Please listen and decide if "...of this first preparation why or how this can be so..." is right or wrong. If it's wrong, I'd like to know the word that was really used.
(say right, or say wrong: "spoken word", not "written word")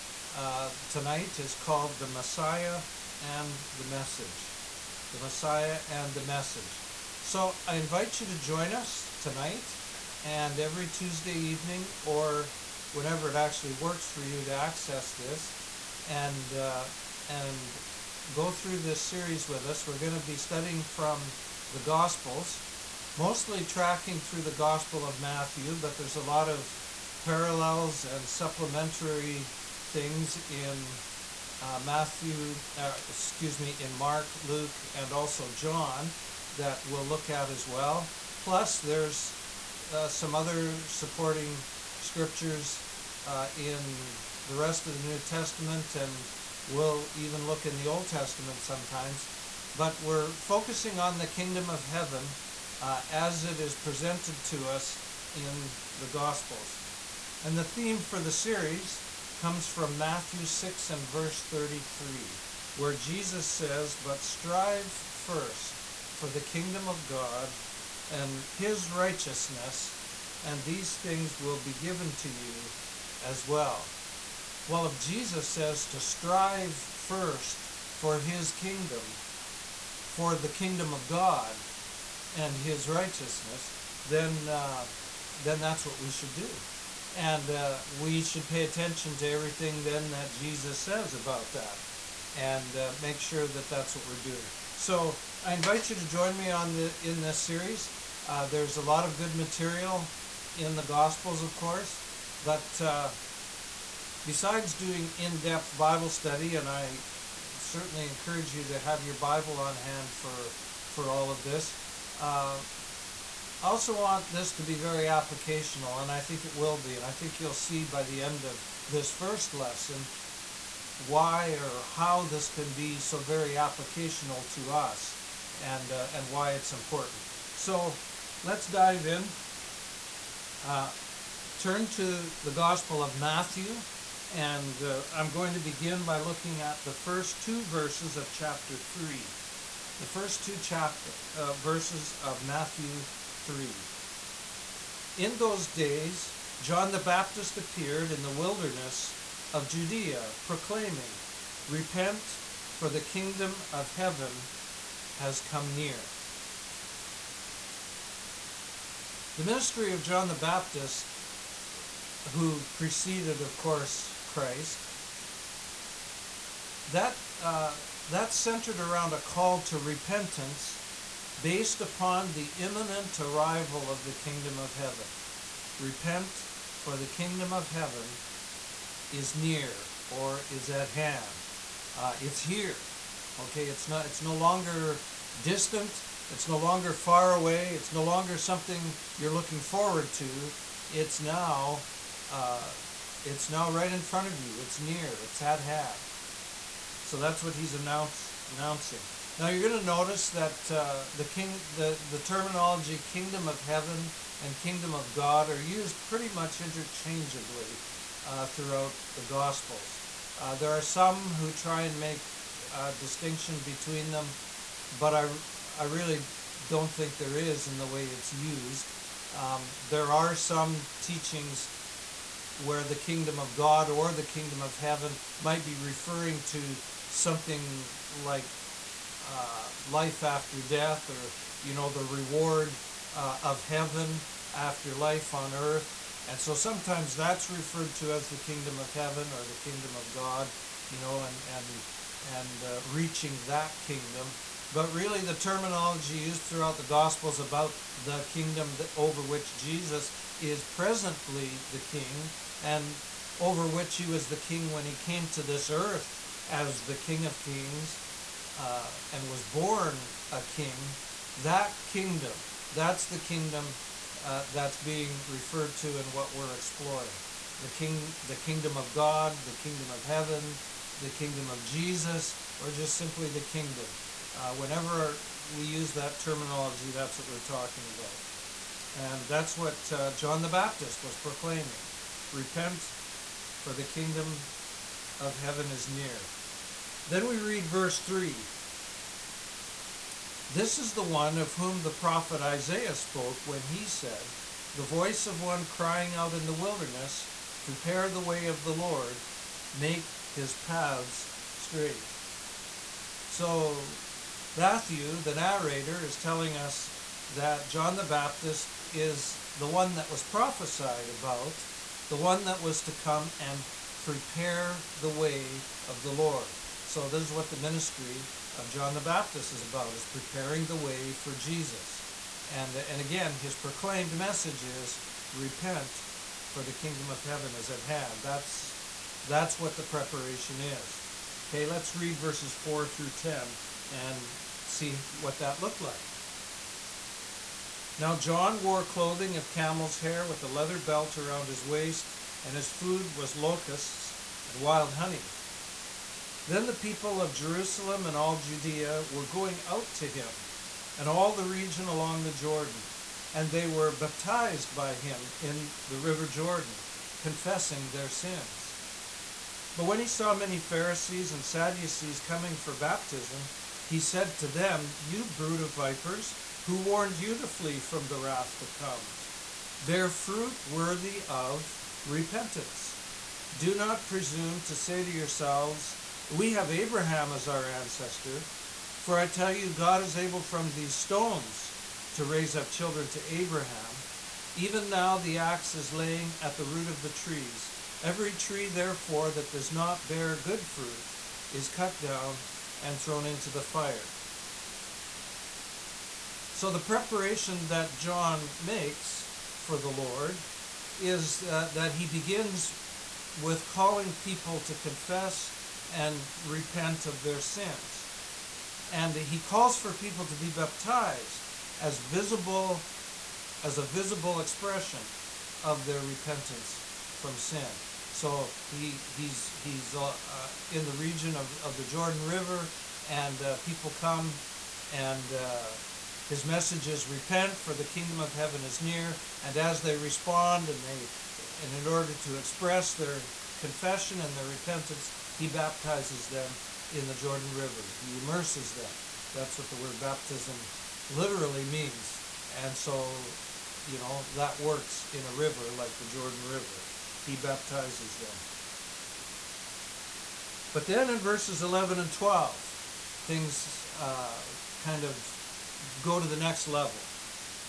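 wrong: "lesson", not "preparation".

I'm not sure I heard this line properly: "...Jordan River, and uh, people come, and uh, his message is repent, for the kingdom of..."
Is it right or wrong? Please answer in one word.
right.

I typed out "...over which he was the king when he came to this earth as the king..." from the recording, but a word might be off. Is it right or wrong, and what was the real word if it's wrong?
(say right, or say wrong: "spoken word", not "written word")
right.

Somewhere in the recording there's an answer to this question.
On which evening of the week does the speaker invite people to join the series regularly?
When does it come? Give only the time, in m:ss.
0:10.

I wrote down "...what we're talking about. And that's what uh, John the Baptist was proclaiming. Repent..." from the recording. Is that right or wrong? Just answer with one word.
right.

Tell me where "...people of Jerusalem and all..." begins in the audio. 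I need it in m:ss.
5:46.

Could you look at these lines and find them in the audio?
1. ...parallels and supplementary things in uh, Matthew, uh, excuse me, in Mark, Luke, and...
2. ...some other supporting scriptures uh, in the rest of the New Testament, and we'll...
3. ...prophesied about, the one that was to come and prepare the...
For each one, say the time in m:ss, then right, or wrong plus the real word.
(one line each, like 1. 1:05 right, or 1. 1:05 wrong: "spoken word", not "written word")
1. 0:27 right
2. 0:40 right
3. 5:10 right.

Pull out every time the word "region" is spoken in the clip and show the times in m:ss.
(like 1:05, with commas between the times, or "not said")
5:51, 7:00.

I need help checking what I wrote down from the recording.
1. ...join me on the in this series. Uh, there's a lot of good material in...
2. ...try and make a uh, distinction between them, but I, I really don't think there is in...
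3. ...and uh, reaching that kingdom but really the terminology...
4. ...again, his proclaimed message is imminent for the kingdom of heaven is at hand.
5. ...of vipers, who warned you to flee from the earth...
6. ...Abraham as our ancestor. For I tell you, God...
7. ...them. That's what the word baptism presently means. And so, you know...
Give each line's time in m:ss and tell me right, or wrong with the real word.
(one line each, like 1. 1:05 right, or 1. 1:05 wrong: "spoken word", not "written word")
1. 1:36 right
2. 3:31 right
3. 4:02 right
4. 5:23 wrong: "repent", not "imminent"
5. 6:05 wrong: "wrath", not "earth"
6. 6:16 right
7. 7:18 wrong: "literally", not "presently".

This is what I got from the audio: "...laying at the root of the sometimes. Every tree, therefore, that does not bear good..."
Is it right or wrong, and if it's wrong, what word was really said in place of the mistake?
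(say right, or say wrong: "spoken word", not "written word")
wrong: "trees", not "sometimes".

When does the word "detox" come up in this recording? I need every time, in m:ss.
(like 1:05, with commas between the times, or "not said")
not said.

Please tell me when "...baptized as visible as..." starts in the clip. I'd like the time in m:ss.
6:50.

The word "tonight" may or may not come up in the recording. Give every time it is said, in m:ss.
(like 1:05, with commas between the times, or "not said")
0:00, 0:09.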